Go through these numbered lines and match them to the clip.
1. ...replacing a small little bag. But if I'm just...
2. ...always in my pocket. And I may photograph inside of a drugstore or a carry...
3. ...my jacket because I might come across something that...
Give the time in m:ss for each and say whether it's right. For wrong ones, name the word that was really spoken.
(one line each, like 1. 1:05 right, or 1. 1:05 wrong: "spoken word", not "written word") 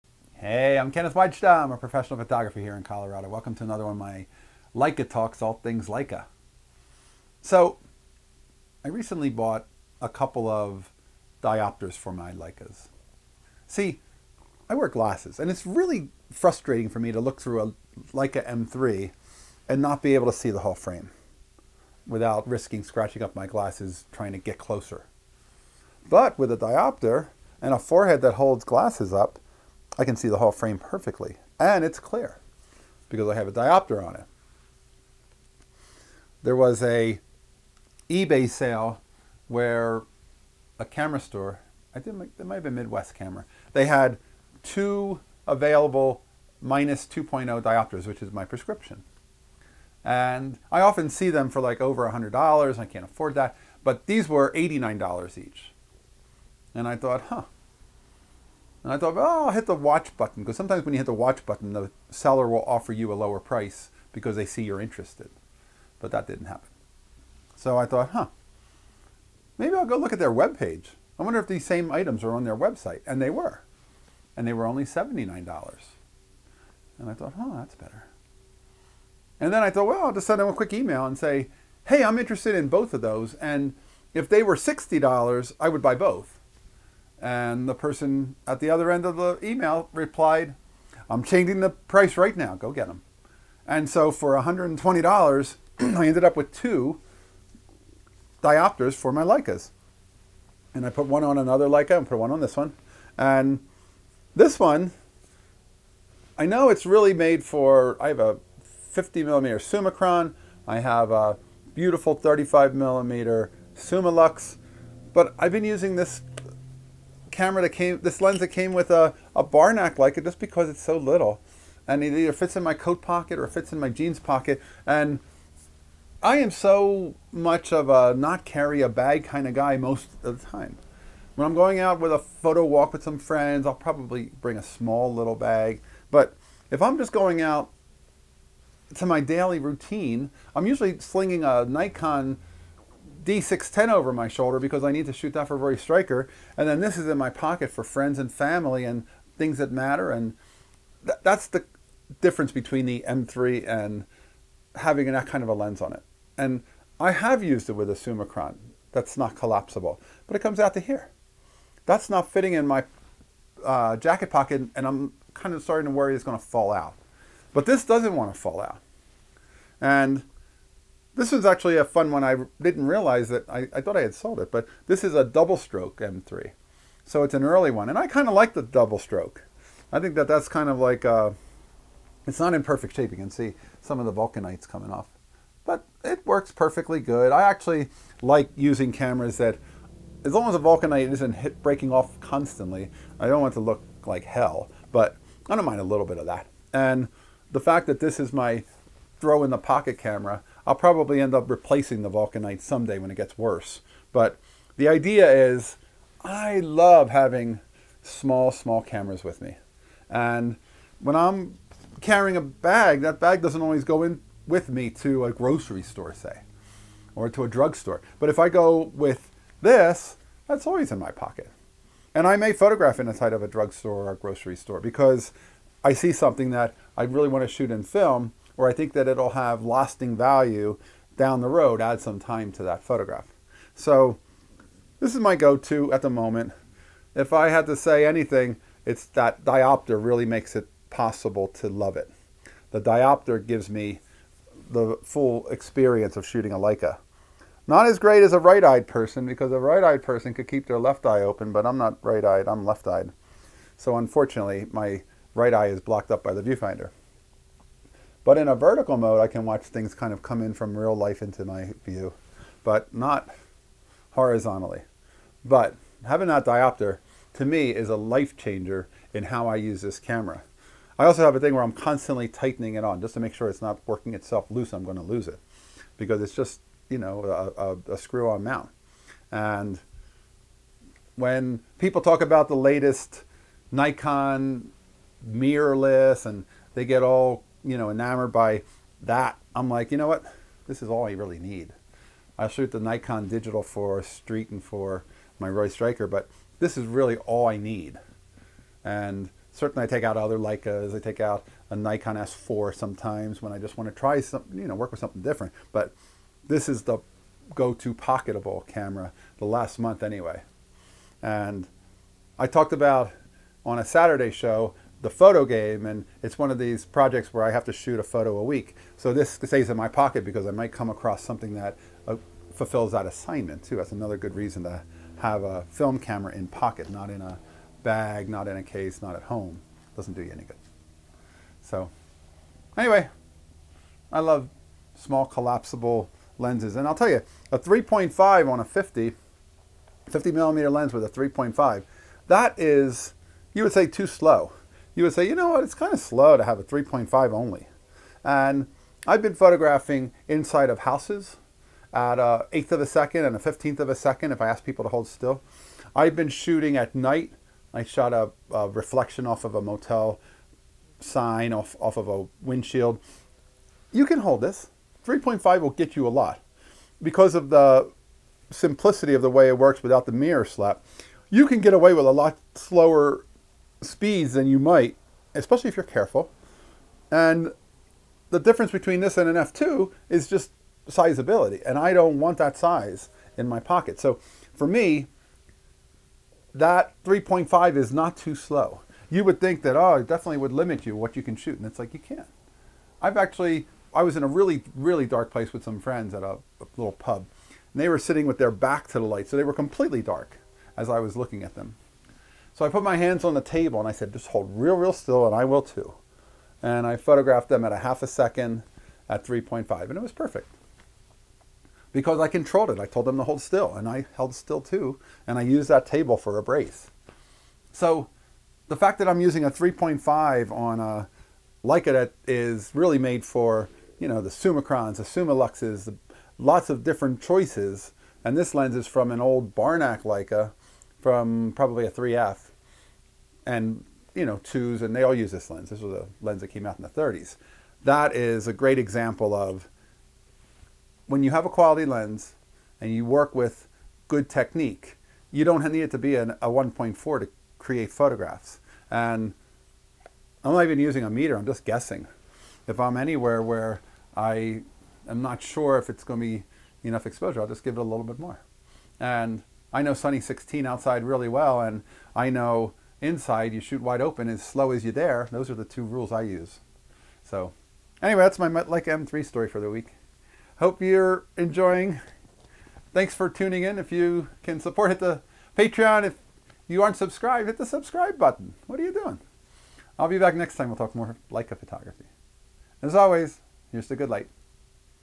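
1. 2:14 wrong: "bring", not "replacing"
2. 3:40 wrong: "grocery", not "carry"
3. 5:19 wrong: "pocket", not "jacket".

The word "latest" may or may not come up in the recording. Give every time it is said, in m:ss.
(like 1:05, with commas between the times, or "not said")
4:42.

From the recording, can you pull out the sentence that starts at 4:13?
So unfortunately, my right eye is blocked up by the viewfinder.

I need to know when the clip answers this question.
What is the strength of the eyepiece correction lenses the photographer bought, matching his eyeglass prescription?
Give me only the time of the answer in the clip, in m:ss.
0:46.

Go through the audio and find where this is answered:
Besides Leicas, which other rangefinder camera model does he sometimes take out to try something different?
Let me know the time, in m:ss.
5:01.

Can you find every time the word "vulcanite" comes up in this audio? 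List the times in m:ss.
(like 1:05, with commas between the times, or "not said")
3:04, 3:10, 3:22.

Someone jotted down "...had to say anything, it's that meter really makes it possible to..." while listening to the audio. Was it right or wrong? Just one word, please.
wrong.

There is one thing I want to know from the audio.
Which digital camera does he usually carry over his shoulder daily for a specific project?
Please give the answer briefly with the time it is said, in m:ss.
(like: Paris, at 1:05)
Nikon D610, at 2:21.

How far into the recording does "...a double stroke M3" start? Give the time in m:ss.
2:55.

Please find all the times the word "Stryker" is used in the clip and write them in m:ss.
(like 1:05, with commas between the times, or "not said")
2:25, 4:55.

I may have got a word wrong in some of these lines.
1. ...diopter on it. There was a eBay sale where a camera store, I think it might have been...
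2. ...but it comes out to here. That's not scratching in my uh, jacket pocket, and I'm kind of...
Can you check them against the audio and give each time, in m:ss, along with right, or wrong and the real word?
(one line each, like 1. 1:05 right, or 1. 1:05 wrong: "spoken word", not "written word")
1. 0:33 right
2. 2:40 wrong: "fitting", not "scratching".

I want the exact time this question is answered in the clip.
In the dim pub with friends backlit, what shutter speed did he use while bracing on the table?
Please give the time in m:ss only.
6:47.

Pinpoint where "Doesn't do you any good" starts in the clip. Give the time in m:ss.
5:29.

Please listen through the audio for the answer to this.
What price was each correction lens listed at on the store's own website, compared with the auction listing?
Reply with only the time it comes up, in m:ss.
1:14.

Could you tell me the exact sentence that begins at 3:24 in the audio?
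But the idea is I love having small, small cameras with me.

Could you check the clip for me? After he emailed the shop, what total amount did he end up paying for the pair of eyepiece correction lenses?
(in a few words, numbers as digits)
$120.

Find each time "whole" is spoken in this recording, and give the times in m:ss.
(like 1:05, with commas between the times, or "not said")
0:20, 0:30.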